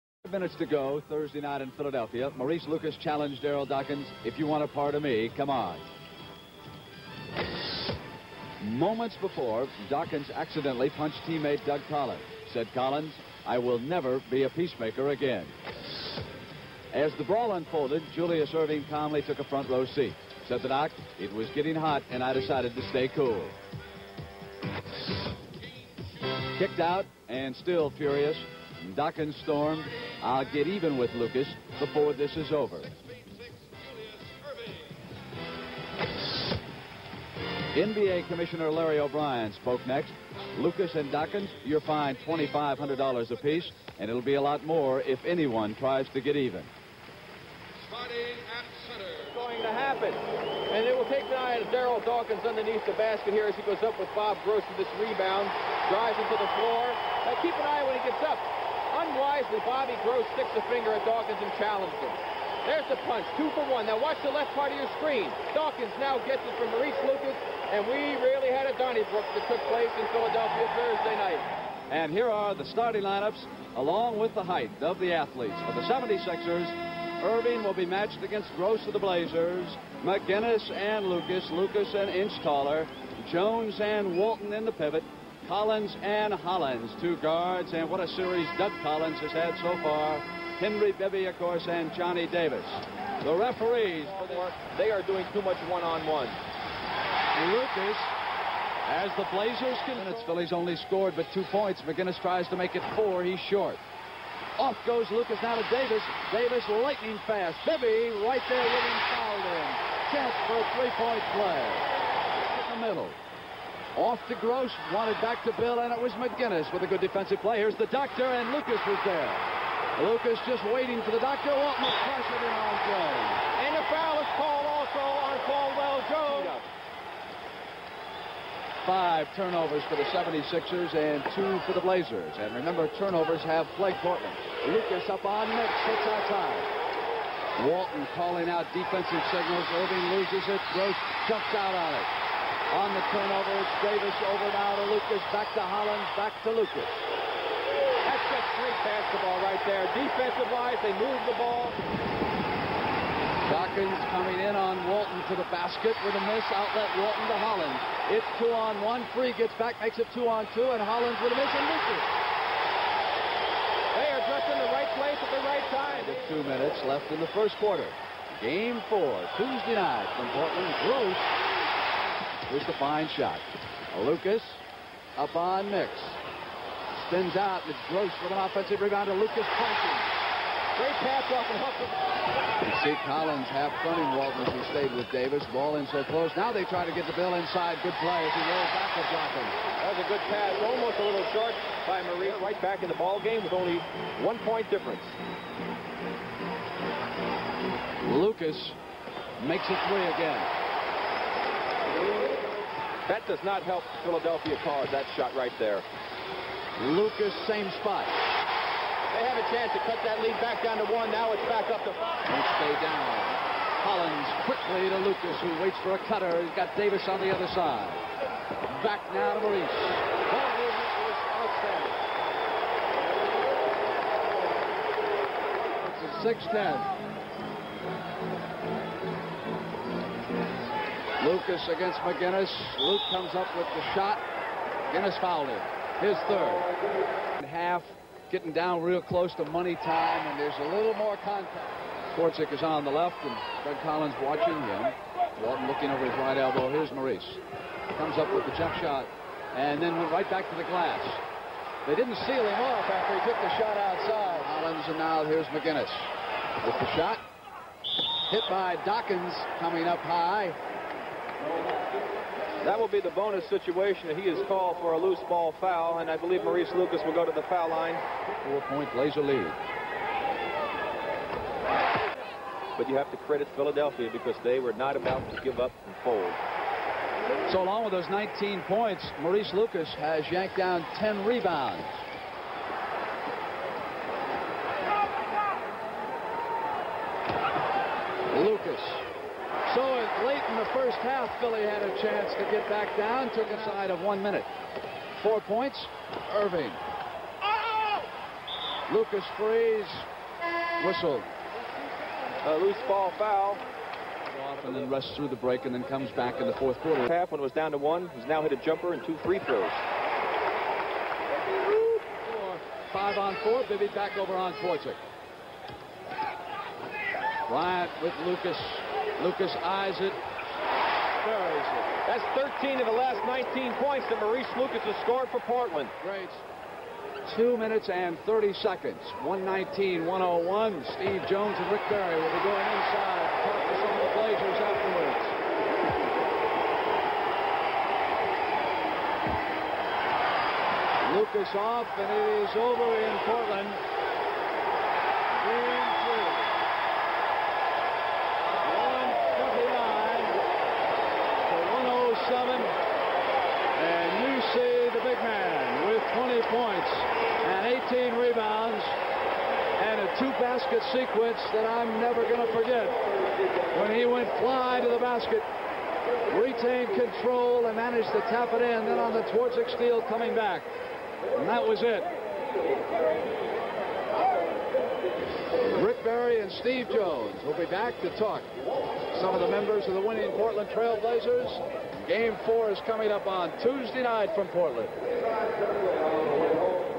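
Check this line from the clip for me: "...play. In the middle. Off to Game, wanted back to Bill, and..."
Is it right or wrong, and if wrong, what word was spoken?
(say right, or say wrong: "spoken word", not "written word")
wrong: "Gross", not "Game".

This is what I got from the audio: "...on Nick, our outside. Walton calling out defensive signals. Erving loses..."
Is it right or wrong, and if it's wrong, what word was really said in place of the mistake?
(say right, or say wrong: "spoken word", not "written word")
right.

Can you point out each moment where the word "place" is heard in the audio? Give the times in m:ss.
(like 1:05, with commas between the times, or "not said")
1:09, 2:44.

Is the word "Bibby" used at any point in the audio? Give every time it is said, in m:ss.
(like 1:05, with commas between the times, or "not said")
1:30, 1:47, 5:13.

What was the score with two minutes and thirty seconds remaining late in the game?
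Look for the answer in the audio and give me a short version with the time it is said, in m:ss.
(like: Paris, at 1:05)
119, 101, at 5:29.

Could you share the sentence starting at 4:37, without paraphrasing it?
So along with those 19 points, Maurice Lucas has yanked down 10 rebounds.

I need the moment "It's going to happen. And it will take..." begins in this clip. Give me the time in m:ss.
0:47.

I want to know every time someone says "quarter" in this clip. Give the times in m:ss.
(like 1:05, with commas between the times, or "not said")
2:47, 5:06.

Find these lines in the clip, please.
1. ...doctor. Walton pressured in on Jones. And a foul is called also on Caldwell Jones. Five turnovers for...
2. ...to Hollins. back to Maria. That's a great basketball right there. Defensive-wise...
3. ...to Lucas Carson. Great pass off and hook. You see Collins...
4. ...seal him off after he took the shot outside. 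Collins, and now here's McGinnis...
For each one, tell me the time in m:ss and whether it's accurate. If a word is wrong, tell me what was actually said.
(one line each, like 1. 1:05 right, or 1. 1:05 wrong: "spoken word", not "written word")
1. 2:01 right
2. 2:25 wrong: "Lucas", not "Maria"
3. 2:59 right
4. 4:12 right.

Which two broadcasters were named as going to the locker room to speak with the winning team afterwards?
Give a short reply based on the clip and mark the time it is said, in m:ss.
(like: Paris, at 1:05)
Steve Jones and Rick Barry, at 5:30.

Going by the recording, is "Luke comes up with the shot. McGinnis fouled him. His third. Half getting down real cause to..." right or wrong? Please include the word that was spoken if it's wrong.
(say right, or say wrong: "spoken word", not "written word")
wrong: "close", not "cause".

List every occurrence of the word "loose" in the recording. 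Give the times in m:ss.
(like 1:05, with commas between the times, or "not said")
4:24, 5:02.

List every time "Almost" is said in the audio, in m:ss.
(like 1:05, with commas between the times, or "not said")
3:10.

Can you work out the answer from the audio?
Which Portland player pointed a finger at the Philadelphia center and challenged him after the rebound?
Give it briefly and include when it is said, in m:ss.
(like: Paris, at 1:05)
Bobby Gross, at 0:59.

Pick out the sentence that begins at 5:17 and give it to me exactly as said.
Bryant with Lucas Lucas eyes it.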